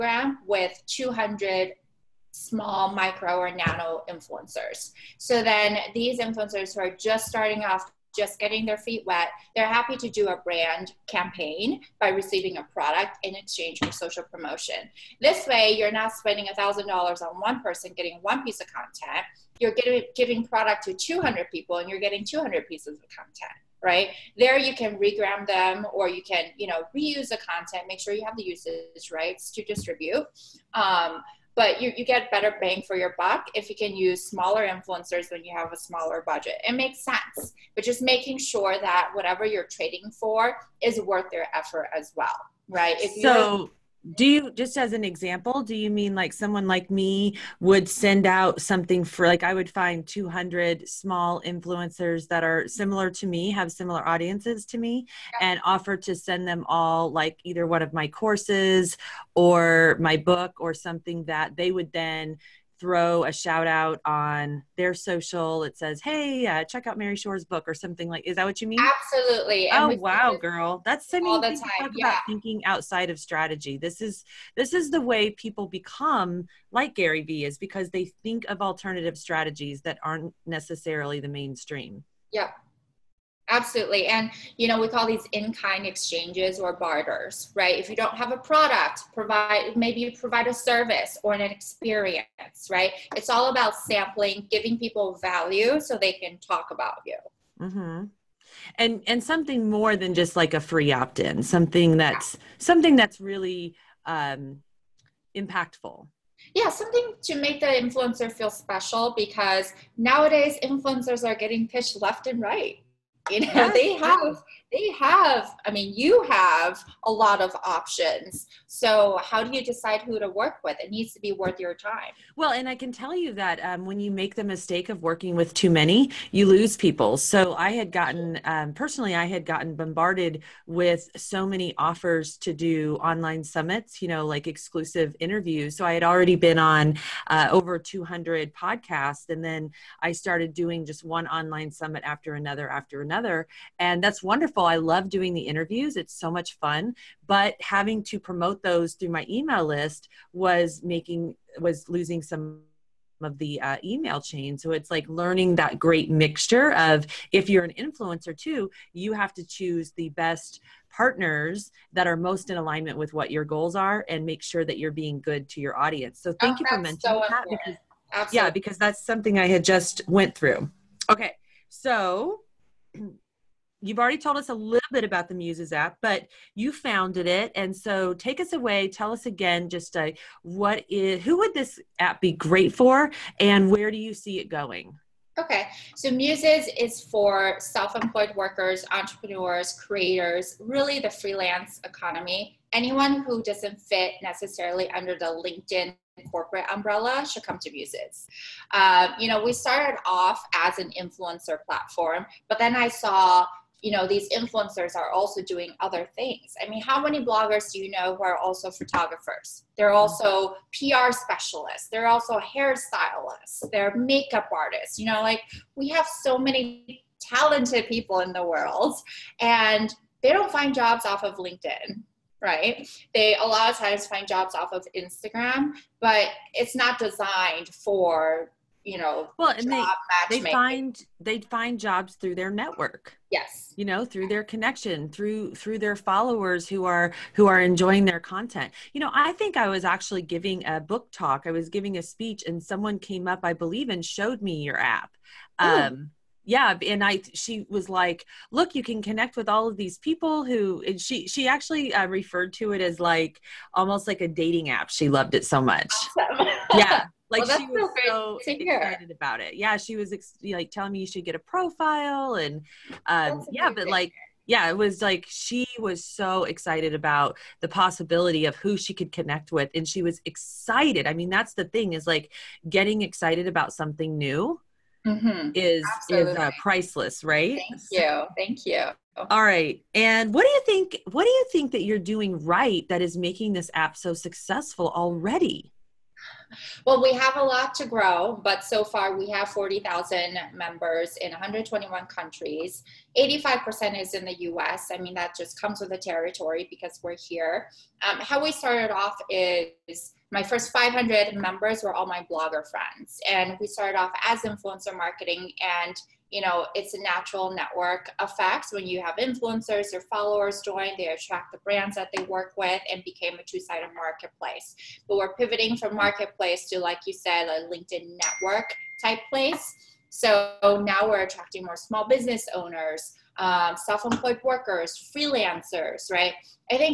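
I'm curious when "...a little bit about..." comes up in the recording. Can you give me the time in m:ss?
2:54.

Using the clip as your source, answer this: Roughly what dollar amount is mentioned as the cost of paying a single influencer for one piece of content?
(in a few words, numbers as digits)
$1,000.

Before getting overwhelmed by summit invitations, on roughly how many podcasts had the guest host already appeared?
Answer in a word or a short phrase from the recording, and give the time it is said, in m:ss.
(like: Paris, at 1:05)
over 200, at 2:17.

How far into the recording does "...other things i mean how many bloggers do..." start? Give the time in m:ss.
3:25.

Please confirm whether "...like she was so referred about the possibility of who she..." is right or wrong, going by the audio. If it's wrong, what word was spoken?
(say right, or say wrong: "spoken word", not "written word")
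wrong: "excited", not "referred".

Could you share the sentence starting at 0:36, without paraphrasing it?
It makes sense, but just making sure that whatever you're trading for is worth their effort as well, right?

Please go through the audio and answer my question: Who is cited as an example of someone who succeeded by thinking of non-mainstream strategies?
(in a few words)
Gary Vee.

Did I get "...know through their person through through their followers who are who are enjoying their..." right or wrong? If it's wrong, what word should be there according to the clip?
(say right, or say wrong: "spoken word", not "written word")
wrong: "connection", not "person".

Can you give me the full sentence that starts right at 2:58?
Tell us again, just uh, what is who would this app be great for, and where do you see it going?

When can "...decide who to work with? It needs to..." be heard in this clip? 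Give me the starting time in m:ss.
1:59.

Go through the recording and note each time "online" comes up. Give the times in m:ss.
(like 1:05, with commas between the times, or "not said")
2:12, 2:21.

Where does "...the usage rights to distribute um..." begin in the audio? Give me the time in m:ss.
0:28.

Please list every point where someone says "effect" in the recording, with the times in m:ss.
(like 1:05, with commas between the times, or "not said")
5:08.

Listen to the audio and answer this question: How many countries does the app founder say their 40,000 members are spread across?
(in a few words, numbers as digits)
121.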